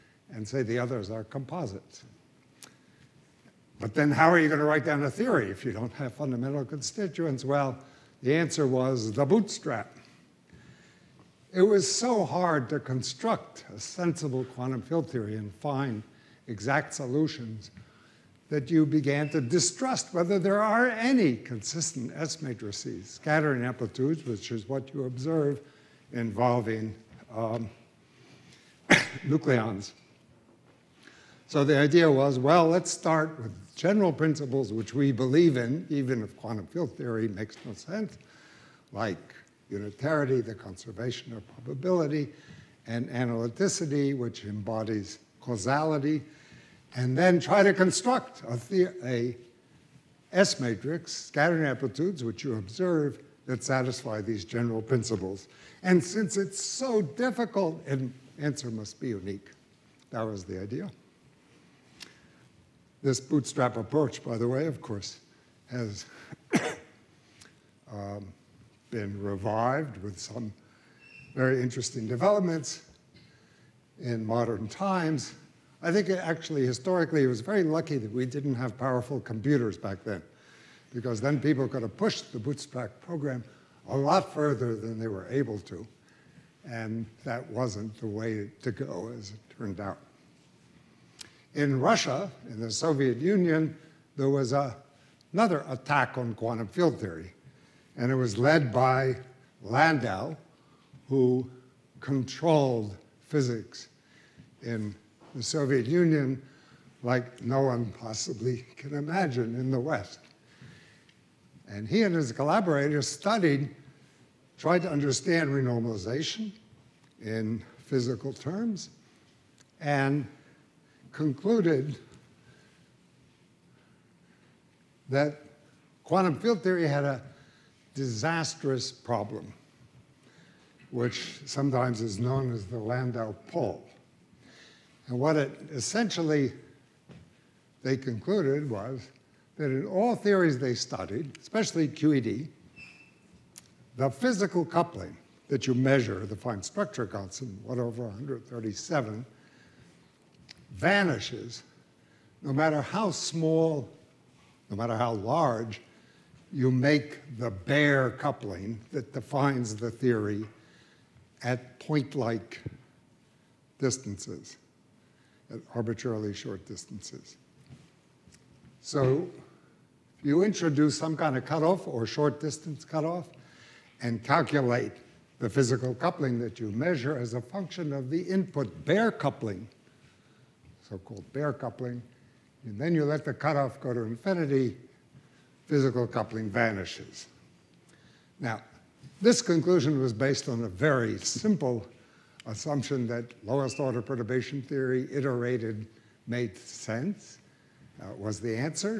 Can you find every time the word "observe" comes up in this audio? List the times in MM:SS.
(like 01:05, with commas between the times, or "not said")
00:25, 00:52.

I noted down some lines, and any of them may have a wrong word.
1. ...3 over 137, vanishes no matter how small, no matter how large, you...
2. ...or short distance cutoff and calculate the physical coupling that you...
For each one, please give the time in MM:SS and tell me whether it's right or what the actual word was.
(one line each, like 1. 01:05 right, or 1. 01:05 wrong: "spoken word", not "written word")
1. 02:27 wrong: "1", not "3"
2. 02:51 right.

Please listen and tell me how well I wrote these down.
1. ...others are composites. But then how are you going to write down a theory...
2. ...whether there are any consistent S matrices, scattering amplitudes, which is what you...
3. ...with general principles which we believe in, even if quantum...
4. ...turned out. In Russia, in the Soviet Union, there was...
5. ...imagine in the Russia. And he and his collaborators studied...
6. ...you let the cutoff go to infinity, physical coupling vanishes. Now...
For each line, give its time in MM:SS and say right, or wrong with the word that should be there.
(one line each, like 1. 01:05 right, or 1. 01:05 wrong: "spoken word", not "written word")
1. 00:00 right
2. 00:20 right
3. 00:33 right
4. 01:29 right
5. 01:48 wrong: "West", not "Russia"
6. 03:02 right.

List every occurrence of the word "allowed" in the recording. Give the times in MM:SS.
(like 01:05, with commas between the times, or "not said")
not said.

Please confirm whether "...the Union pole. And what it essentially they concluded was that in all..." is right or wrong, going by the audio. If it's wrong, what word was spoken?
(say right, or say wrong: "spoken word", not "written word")
wrong: "Landau", not "Union".